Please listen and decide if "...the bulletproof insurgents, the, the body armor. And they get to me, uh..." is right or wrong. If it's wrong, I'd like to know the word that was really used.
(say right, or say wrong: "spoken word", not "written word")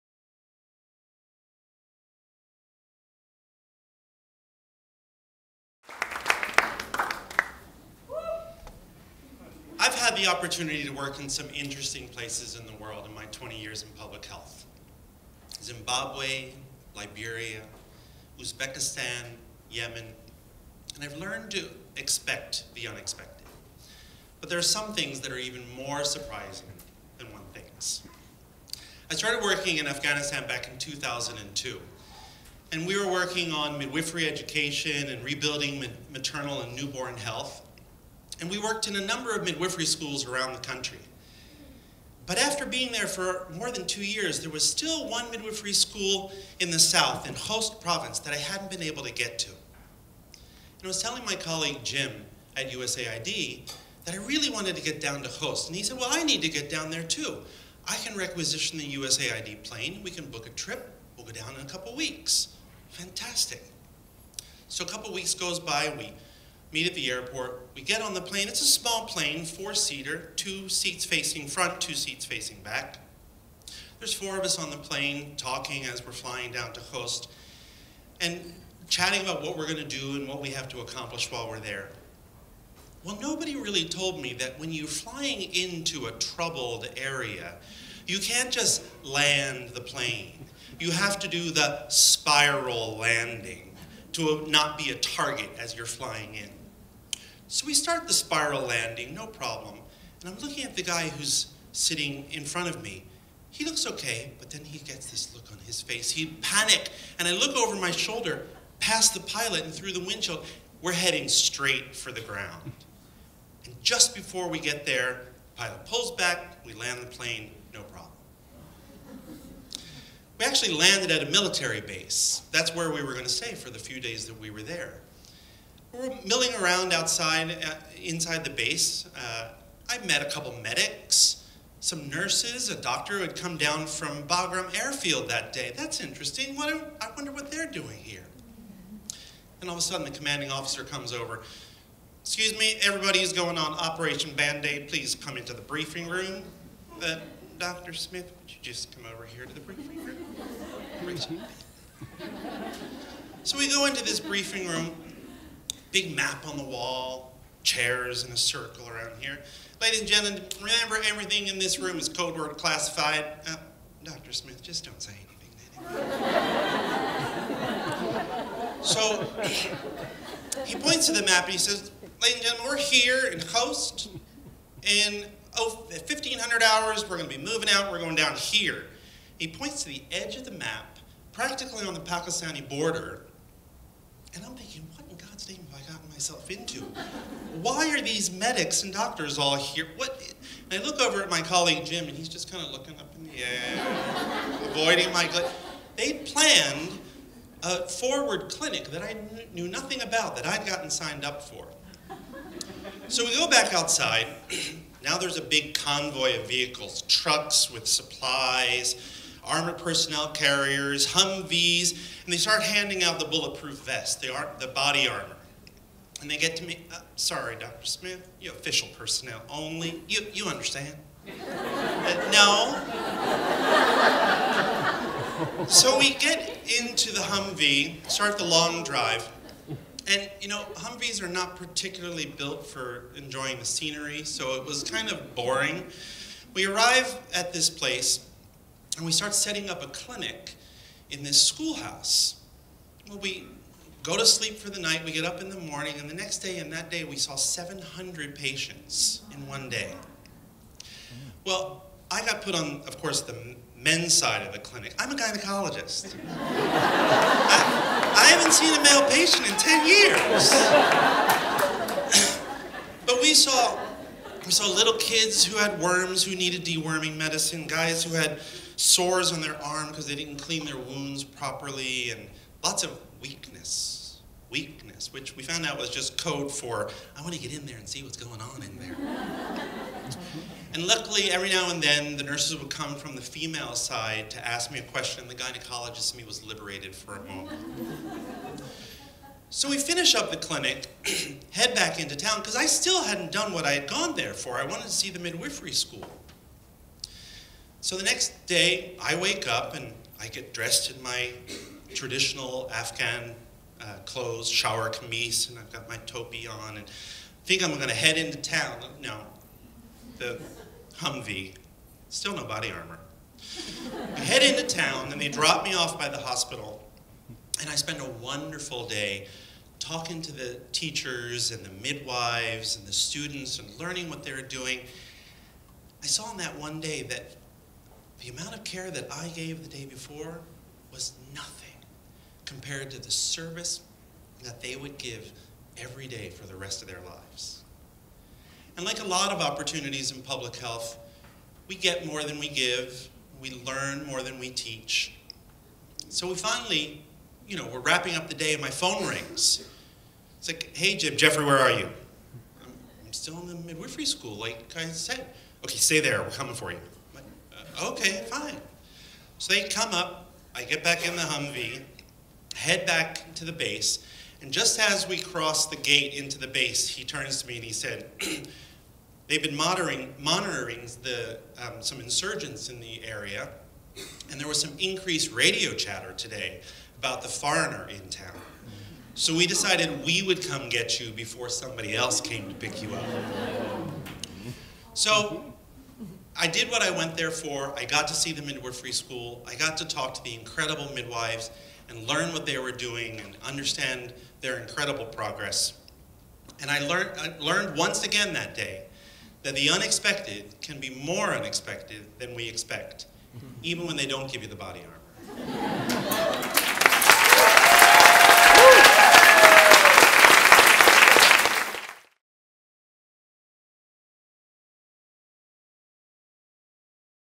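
wrong: "vests", not "insurgents".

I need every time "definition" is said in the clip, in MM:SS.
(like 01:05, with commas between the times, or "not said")
not said.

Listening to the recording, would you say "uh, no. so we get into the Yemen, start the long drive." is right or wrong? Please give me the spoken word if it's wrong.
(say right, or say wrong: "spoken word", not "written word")
wrong: "Humvee", not "Yemen".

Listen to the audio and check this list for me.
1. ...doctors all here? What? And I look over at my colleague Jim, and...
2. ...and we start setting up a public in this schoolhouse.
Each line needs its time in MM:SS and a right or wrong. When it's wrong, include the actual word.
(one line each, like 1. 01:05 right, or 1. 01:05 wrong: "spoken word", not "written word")
1. 03:08 right
2. 03:58 wrong: "clinic", not "public".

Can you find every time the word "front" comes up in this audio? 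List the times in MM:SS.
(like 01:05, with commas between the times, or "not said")
01:11, 01:42.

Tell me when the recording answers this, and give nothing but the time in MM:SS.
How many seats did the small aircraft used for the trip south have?
01:09.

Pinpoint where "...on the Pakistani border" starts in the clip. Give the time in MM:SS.
03:01.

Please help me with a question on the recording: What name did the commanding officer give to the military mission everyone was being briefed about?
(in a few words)
Operation Band-Aid.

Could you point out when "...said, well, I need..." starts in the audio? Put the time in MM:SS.
00:55.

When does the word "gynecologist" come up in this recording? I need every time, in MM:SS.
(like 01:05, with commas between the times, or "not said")
04:15, 04:45.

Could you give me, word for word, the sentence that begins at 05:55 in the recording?
Okay, stay there, we're coming for you.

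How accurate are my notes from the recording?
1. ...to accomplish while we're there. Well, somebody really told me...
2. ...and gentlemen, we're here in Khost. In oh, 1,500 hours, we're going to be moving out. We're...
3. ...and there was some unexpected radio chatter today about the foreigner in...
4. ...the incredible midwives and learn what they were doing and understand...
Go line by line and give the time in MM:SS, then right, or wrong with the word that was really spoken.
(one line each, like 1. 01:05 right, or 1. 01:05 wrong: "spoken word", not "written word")
1. 01:20 wrong: "nobody", not "somebody"
2. 02:52 right
3. 06:14 wrong: "increased", not "unexpected"
4. 06:30 right.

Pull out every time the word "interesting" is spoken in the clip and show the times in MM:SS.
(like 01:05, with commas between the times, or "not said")
00:11, 02:15.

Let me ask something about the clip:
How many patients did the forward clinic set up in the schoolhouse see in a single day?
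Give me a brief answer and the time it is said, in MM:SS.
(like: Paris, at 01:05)
700, at 04:07.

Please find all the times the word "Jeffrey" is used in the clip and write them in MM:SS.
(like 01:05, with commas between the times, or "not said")
05:51.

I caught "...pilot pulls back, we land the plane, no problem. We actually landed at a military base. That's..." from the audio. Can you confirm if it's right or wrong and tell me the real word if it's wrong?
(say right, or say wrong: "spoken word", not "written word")
right.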